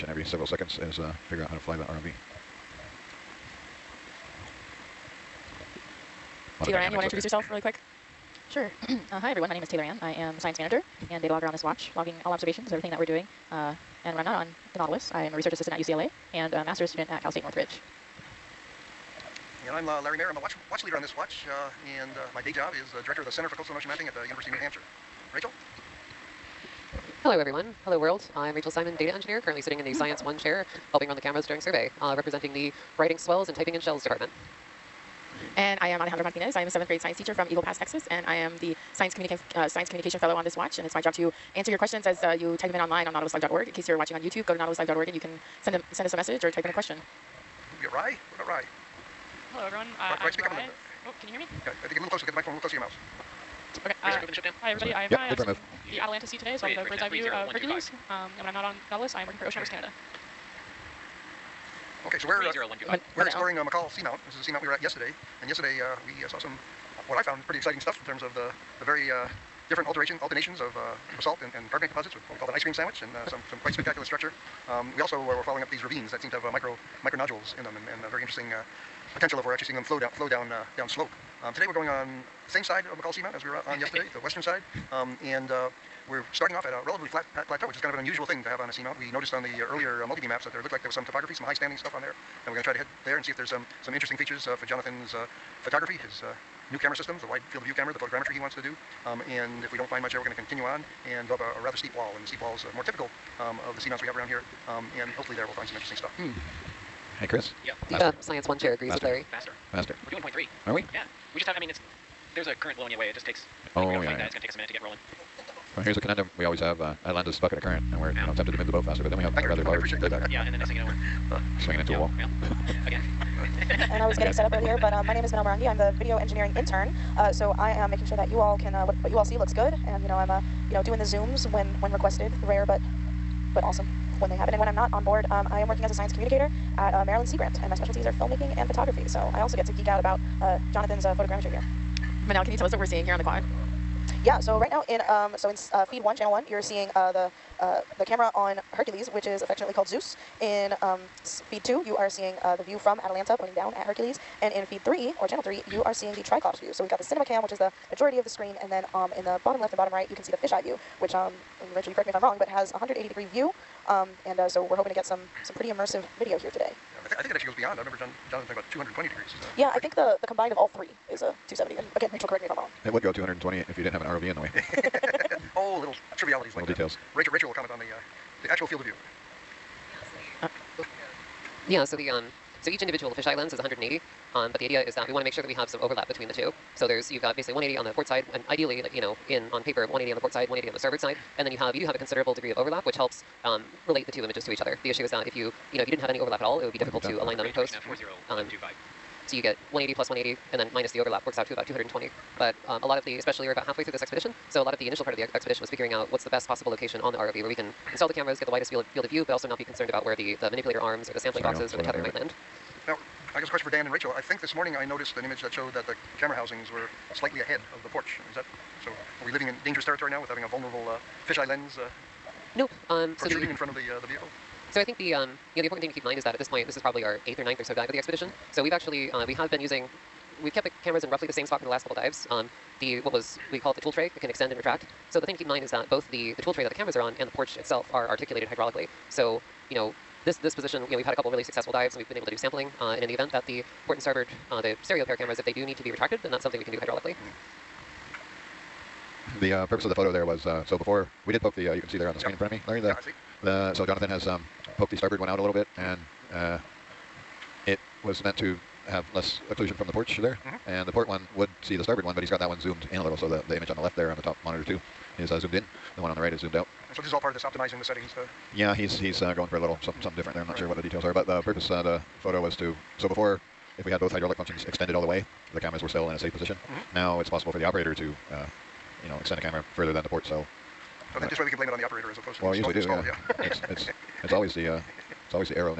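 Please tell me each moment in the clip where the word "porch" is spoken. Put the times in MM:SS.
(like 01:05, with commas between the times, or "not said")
03:37, 03:57, 04:19.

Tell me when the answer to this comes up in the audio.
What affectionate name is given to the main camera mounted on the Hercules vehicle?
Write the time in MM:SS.
02:29.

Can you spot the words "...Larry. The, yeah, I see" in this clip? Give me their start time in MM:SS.
04:12.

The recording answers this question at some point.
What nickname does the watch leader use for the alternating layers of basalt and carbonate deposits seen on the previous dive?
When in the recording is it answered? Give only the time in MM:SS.
01:12.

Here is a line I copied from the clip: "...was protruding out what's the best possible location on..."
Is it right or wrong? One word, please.
wrong.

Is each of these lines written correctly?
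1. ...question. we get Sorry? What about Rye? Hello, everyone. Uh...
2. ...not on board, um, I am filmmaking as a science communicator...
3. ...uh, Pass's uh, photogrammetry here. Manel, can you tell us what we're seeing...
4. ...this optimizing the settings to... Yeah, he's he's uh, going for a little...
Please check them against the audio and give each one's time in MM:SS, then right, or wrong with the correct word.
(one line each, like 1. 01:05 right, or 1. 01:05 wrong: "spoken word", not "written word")
1. 00:46 wrong: "Rye", not "Sorry"
2. 02:14 wrong: "working", not "filmmaking"
3. 02:20 wrong: "Jonathan", not "Pass"
4. 04:27 right.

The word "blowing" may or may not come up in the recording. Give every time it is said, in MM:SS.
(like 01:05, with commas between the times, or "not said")
01:52.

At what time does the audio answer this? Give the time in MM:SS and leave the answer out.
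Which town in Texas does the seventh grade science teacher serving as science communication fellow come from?
00:37.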